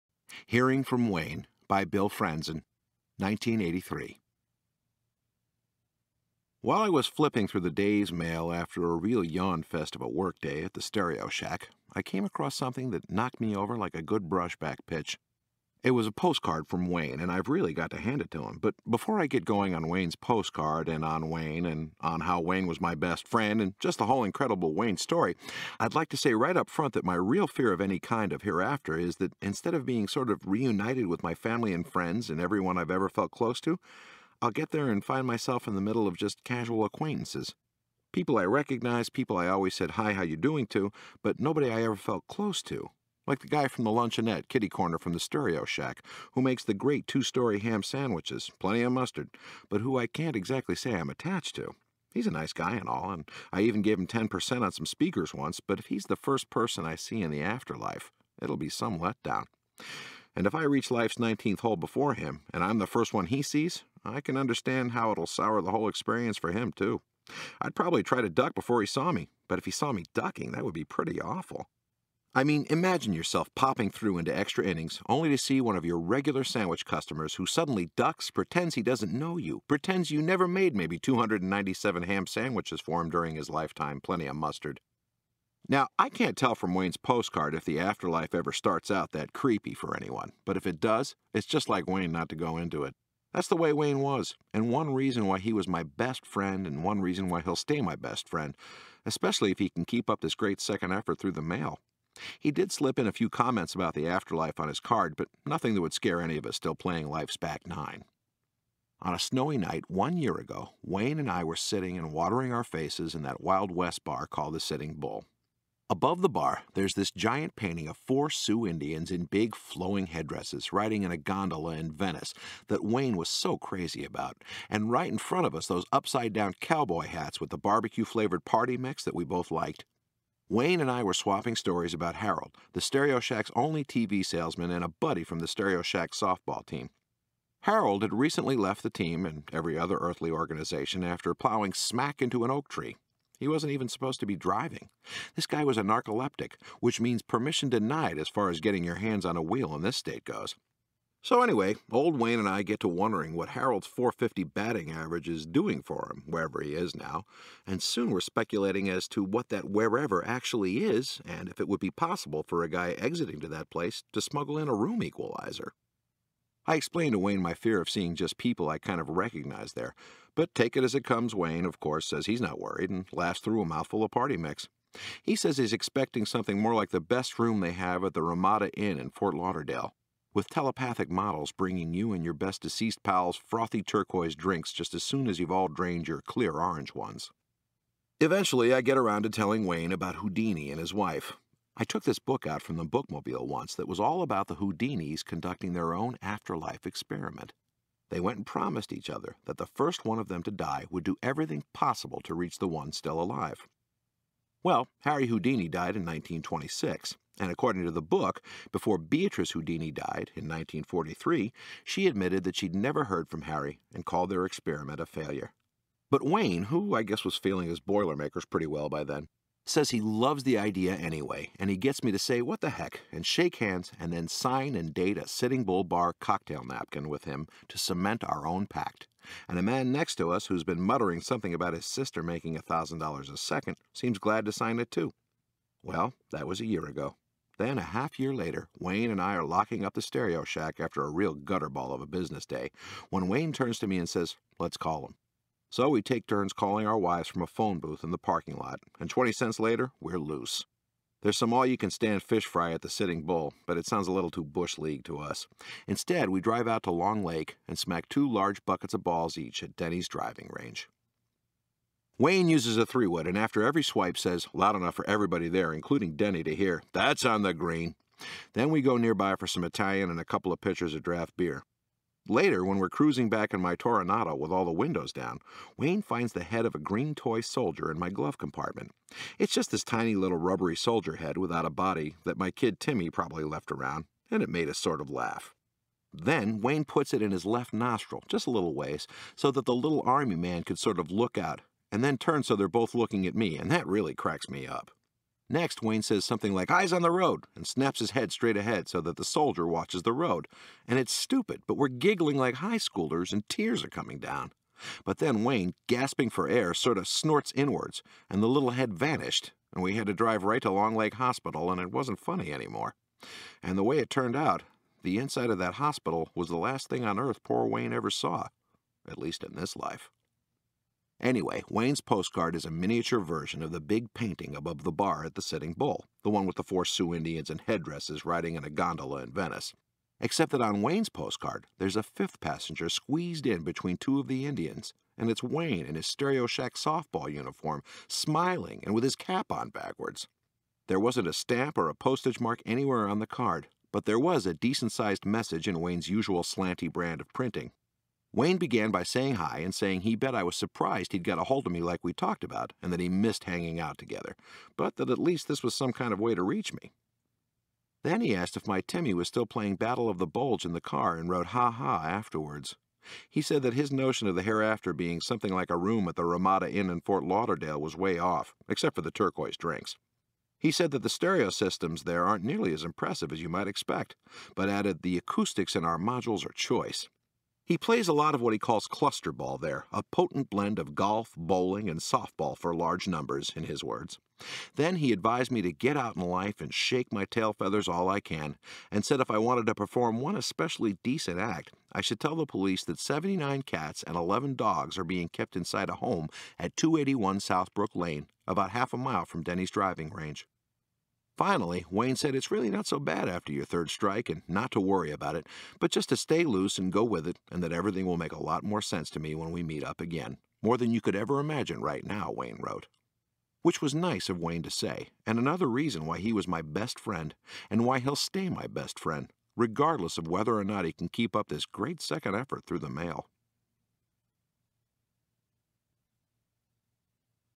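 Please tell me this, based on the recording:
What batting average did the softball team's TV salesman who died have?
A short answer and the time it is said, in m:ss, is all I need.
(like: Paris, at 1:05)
450, at 2:33.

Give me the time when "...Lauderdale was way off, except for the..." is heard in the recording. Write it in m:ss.
6:07.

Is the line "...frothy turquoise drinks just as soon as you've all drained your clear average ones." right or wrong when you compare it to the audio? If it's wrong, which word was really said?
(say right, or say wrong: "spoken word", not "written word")
wrong: "orange", not "average".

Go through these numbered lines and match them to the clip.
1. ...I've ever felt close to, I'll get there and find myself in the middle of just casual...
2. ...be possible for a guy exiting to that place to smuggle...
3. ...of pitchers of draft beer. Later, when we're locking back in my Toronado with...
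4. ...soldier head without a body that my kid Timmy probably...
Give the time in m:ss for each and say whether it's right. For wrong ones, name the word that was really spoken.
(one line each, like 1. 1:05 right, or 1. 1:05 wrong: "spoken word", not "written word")
1. 0:32 right
2. 2:41 right
3. 4:30 wrong: "cruising", not "locking"
4. 4:40 right.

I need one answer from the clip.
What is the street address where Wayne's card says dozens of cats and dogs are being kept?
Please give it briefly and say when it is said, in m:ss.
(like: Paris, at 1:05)
281 Southbrook Lane, at 6:36.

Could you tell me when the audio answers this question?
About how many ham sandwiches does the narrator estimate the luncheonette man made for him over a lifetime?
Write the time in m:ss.
1:20.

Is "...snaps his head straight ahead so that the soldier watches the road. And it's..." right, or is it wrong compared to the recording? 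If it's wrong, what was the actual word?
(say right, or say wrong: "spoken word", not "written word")
right.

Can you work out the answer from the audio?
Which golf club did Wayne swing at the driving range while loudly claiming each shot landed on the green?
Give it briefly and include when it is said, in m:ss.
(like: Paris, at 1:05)
three-wood, at 4:22.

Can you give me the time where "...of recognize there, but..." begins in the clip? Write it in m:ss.
2:48.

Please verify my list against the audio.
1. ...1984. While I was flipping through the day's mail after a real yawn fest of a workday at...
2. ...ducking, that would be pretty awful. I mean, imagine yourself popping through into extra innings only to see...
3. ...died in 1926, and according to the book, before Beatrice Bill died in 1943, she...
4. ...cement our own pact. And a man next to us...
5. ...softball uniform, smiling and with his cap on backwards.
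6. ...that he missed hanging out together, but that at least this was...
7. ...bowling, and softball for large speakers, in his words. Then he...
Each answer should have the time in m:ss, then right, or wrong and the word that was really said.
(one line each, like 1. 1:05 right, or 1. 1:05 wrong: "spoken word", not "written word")
1. 0:03 wrong: "1983", not "1984"
2. 1:10 right
3. 3:25 wrong: "Houdini", not "Bill"
4. 3:47 right
5. 5:36 right
6. 5:52 right
7. 6:21 wrong: "numbers", not "speakers".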